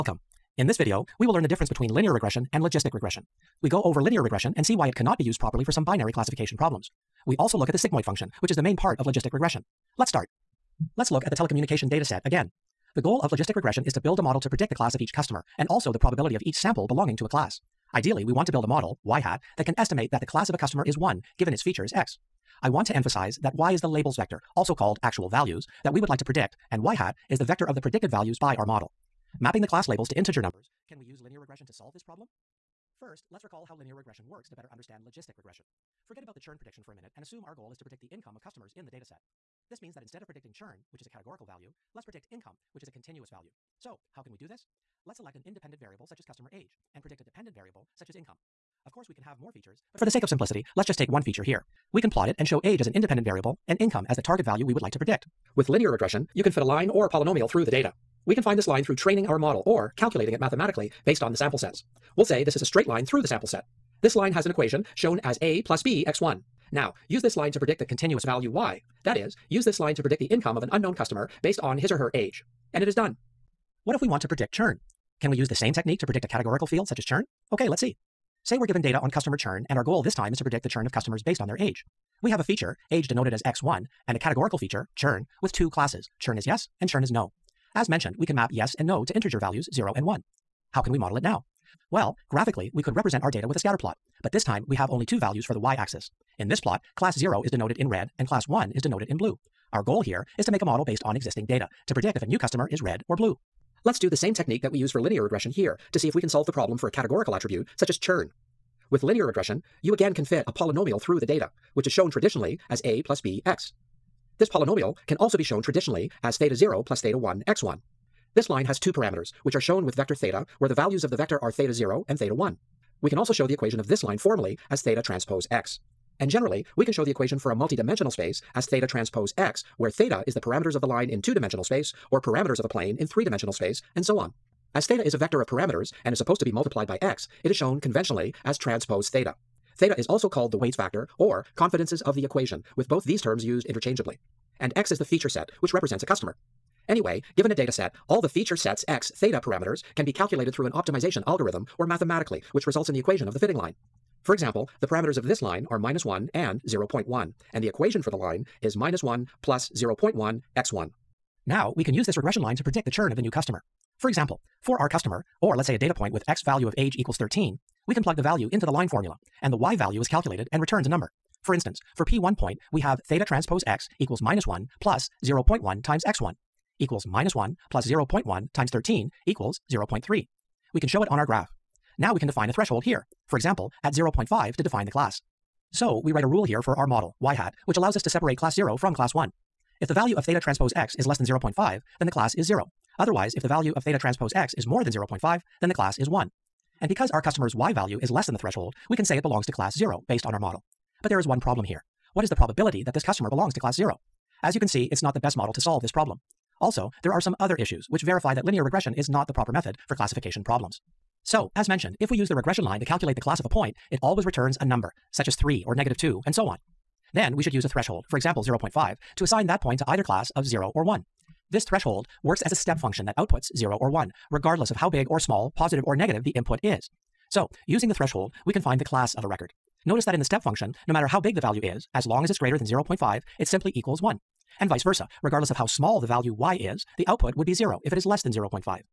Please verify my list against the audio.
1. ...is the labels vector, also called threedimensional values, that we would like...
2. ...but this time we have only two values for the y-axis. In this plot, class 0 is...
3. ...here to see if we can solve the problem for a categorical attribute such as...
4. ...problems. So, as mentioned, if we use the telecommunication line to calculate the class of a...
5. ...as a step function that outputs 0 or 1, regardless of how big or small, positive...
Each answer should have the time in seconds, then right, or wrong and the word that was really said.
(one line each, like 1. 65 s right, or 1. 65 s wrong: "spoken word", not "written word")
1. 23 s wrong: "actual", not "threedimensional"
2. 94 s right
3. 105 s right
4. 210 s wrong: "regression", not "telecommunication"
5. 222 s right.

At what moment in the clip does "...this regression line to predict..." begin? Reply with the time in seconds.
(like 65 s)
162 s.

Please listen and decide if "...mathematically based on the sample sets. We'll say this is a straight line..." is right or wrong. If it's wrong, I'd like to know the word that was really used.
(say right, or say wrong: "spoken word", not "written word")
right.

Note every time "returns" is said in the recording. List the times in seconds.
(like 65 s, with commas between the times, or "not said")
170 s, 214 s.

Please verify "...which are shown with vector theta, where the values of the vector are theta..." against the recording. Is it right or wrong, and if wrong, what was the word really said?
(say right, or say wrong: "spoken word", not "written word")
right.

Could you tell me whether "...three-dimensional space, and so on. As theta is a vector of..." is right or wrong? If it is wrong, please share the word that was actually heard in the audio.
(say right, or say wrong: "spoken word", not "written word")
right.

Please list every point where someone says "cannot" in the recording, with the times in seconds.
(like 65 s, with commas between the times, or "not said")
4 s.